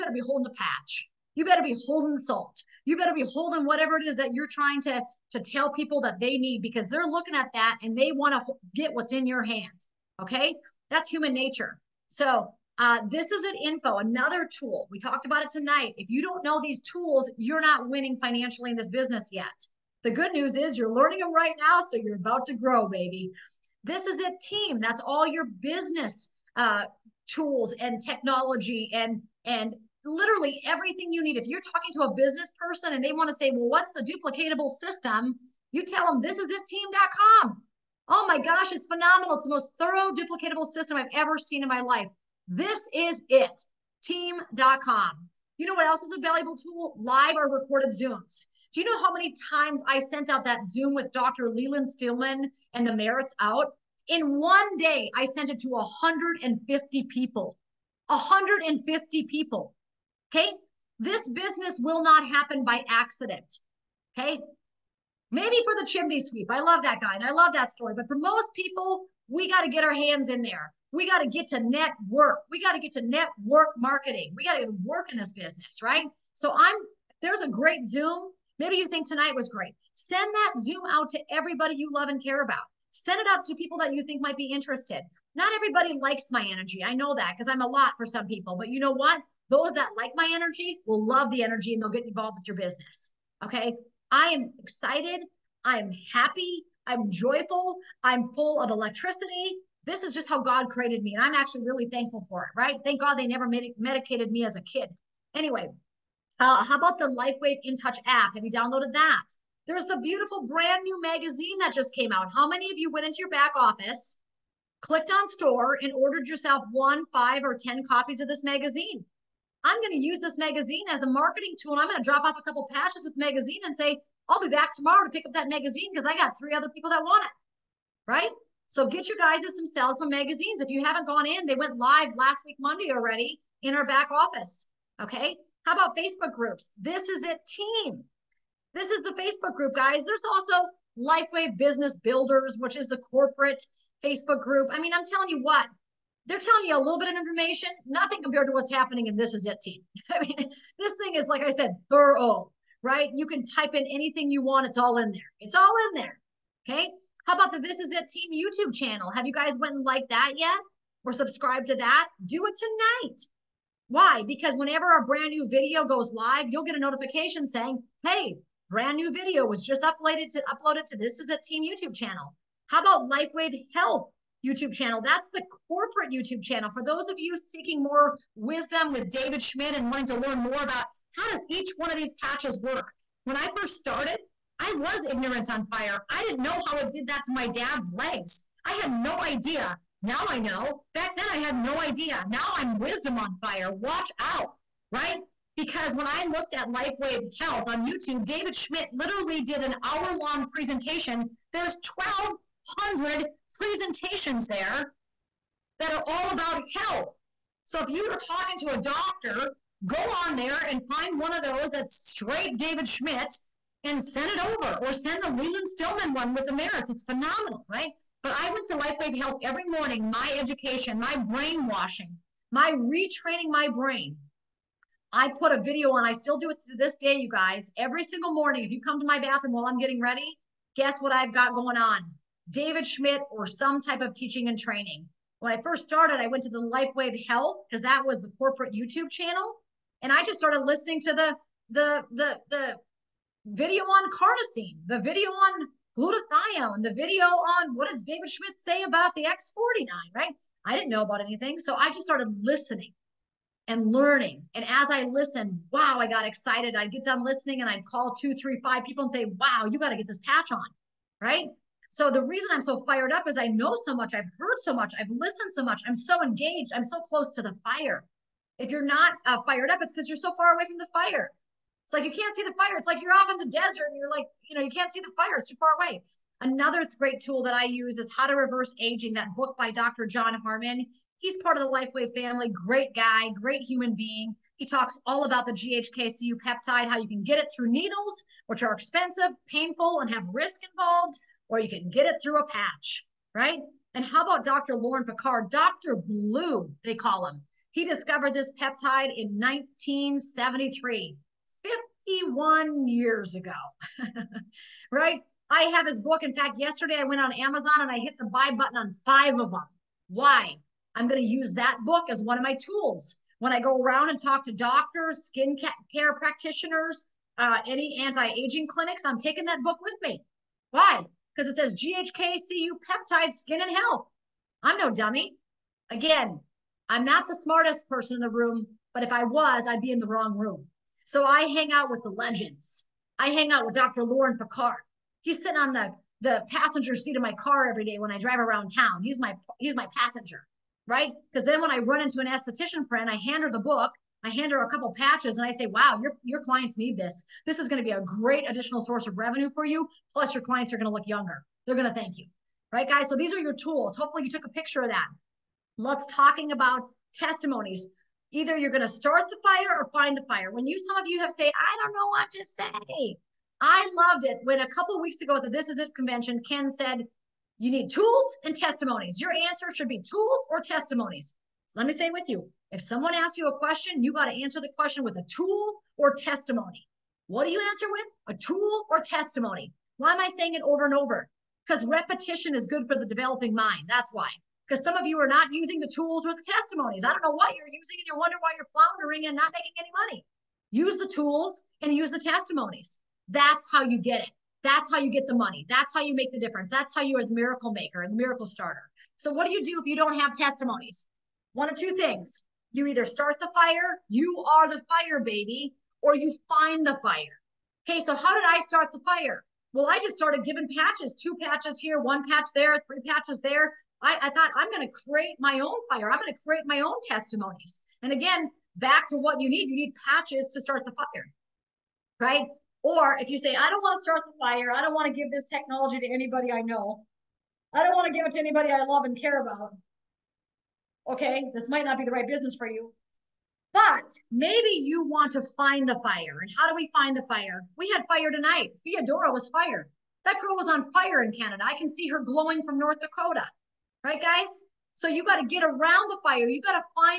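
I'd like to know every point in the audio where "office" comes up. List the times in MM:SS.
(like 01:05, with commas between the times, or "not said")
01:53, 02:14.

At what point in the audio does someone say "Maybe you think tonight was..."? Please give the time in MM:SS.
01:18.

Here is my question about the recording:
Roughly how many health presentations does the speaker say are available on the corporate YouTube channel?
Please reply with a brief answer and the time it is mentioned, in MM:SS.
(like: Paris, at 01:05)
1,200, at 03:22.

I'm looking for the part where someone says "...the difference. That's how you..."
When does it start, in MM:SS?
06:36.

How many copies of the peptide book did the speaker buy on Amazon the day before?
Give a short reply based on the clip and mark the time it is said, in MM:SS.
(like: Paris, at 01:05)
5, at 05:09.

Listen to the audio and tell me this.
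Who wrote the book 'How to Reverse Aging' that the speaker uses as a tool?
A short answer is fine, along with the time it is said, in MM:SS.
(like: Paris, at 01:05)
Dr. John Harmon, at 04:39.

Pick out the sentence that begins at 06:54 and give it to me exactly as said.
I, I thought I'm going to create my own fire.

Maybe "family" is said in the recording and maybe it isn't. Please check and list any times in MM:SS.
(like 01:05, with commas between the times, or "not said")
04:42.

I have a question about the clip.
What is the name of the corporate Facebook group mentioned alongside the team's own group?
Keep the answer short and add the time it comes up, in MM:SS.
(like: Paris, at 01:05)
LifeWave Business Builders, at 02:20.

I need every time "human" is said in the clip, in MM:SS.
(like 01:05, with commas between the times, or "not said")
00:11, 04:43.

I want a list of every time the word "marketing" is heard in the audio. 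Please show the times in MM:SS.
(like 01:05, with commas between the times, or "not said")
01:13, 02:01.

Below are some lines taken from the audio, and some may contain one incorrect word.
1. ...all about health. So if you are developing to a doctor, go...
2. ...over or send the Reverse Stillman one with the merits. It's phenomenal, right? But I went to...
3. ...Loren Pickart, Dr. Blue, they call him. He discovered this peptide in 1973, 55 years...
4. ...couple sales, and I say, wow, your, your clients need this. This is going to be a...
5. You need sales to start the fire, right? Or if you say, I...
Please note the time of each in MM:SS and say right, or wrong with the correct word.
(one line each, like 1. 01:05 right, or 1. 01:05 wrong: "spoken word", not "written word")
1. 03:26 wrong: "talking", not "developing"
2. 03:34 wrong: "Leland", not "Reverse"
3. 04:54 wrong: "51", not "55"
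4. 05:44 wrong: "patches", not "sales"
5. 06:59 wrong: "patches", not "sales".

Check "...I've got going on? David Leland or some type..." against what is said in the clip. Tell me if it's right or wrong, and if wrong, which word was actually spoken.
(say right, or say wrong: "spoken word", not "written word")
wrong: "Schmidt", not "Leland".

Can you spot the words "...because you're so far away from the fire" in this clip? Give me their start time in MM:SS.
04:29.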